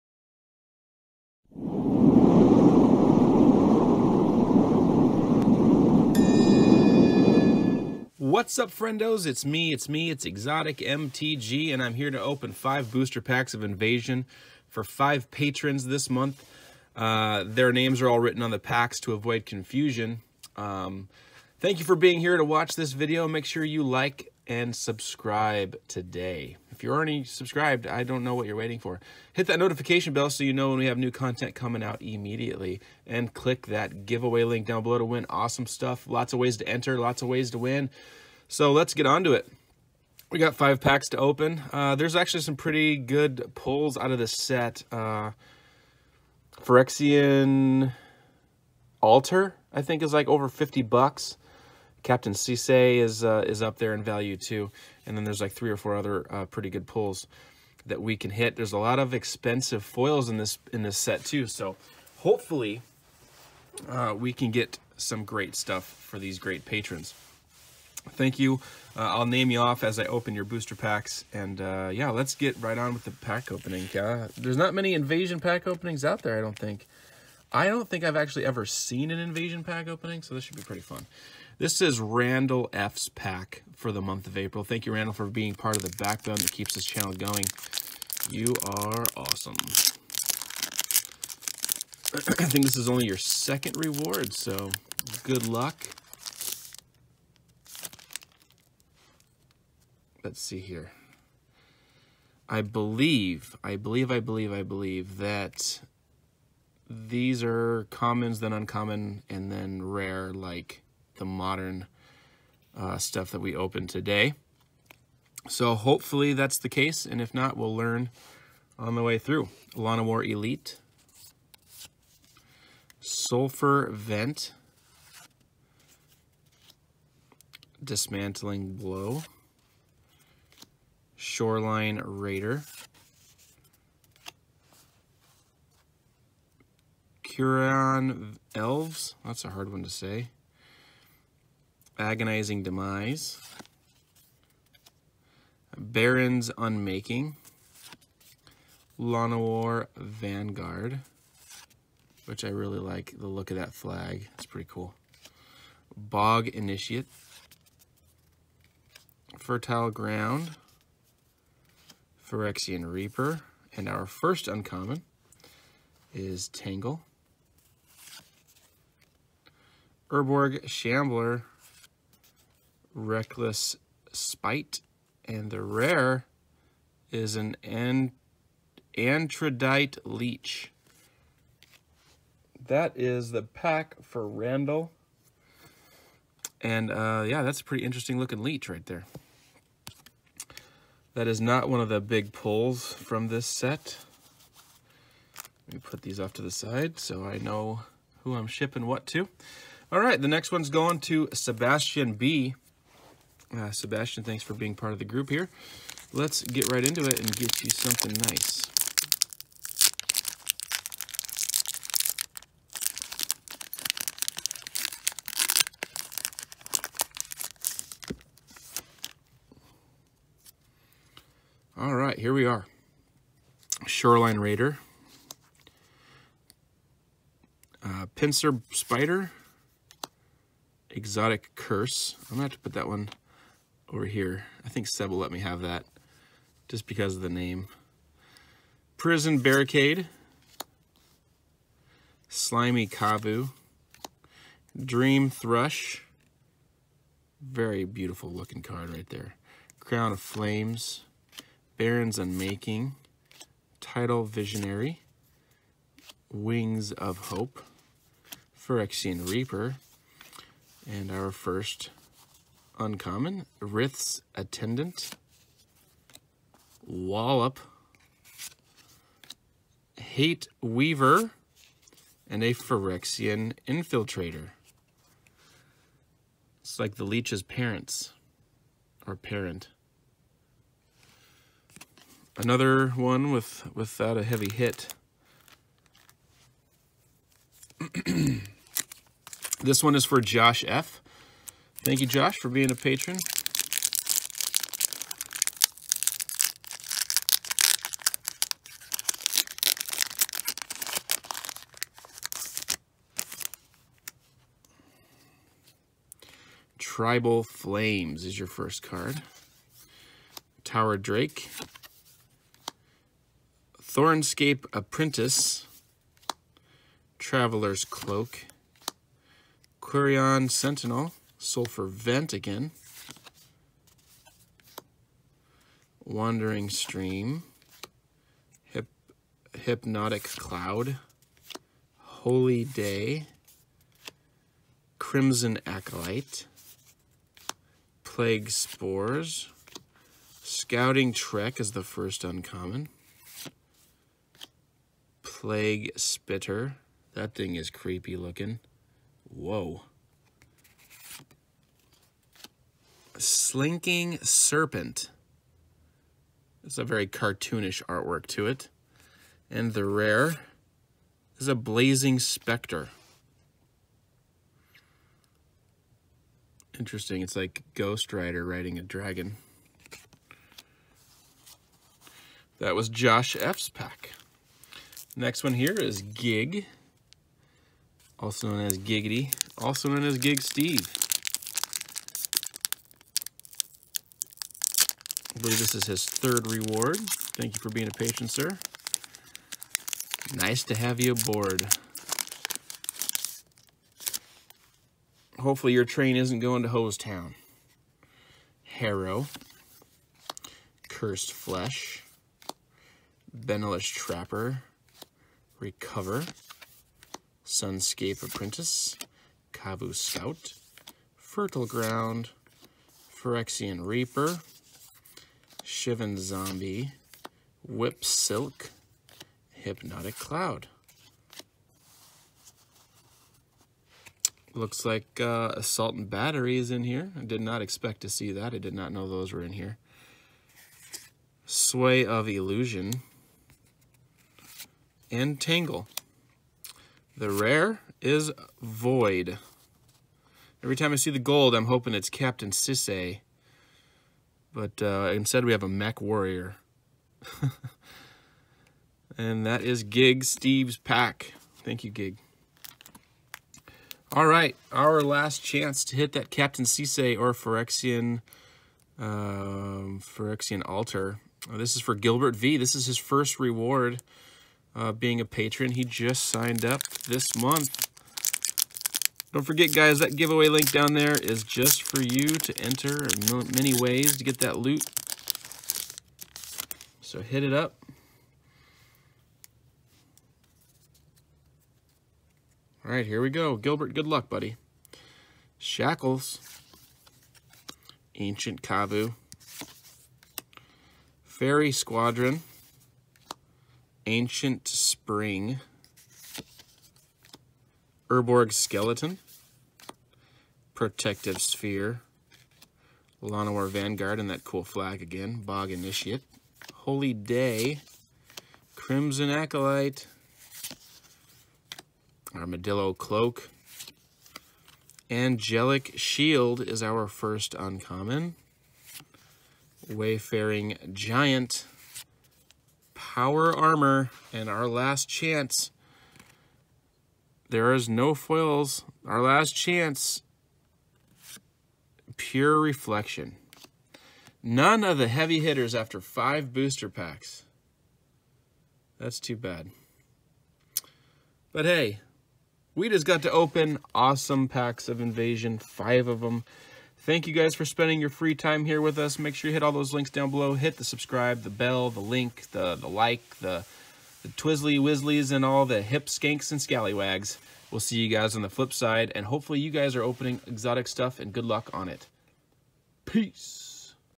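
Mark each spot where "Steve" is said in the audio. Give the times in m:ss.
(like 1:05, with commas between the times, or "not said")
6:20, 7:30.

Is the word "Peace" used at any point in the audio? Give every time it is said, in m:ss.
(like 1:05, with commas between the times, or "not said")
9:23.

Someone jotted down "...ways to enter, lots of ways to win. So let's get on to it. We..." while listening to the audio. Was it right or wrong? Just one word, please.
right.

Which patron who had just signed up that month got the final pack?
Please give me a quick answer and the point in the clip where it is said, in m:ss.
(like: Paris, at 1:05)
Gilbert V, at 7:41.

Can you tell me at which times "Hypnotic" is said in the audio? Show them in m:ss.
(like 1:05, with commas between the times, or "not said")
5:29, 6:59.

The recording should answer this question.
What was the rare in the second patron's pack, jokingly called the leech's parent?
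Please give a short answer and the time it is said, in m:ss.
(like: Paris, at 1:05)
Phyrexian Infiltrator, at 4:32.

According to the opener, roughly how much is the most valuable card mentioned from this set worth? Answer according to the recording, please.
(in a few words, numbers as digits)
over 50 bucks.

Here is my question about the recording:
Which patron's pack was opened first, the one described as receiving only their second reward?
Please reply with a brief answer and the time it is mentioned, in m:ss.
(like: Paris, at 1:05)
Randall F, at 1:21.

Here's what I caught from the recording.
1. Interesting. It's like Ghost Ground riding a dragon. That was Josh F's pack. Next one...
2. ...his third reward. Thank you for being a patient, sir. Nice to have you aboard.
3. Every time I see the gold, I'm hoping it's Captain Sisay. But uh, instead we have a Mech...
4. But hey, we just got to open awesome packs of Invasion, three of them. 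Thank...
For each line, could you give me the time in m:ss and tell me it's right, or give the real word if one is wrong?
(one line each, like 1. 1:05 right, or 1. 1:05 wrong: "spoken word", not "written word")
1. 6:06 wrong: "Rider", not "Ground"
2. 6:25 right
3. 7:20 right
4. 9:01 wrong: "five", not "three".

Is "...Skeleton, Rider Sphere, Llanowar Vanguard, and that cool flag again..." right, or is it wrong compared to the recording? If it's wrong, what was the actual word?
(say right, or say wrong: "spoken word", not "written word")
wrong: "Protective", not "Rider".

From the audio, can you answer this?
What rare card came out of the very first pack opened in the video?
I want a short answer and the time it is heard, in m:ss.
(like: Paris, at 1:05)
Andradite Leech, at 2:58.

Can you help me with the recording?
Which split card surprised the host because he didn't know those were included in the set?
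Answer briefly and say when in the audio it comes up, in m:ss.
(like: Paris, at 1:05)
Assault and Battery, at 7:05.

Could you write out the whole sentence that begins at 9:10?
Hit the subscribe, the bell, the link, the, the like, the, the twizzly wizzlies, and all the hip skanks and scallywags.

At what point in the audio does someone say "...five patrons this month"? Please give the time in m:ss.
0:14.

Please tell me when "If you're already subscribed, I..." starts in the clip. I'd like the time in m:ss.
0:26.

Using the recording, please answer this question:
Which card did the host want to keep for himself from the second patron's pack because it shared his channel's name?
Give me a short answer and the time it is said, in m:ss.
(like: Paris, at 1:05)
Exotic Curse, at 3:50.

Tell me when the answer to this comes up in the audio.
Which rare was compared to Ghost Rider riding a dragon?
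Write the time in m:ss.
6:01.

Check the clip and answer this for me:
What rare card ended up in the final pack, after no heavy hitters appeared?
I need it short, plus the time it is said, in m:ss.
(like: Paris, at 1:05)
Pure Reflection, at 8:52.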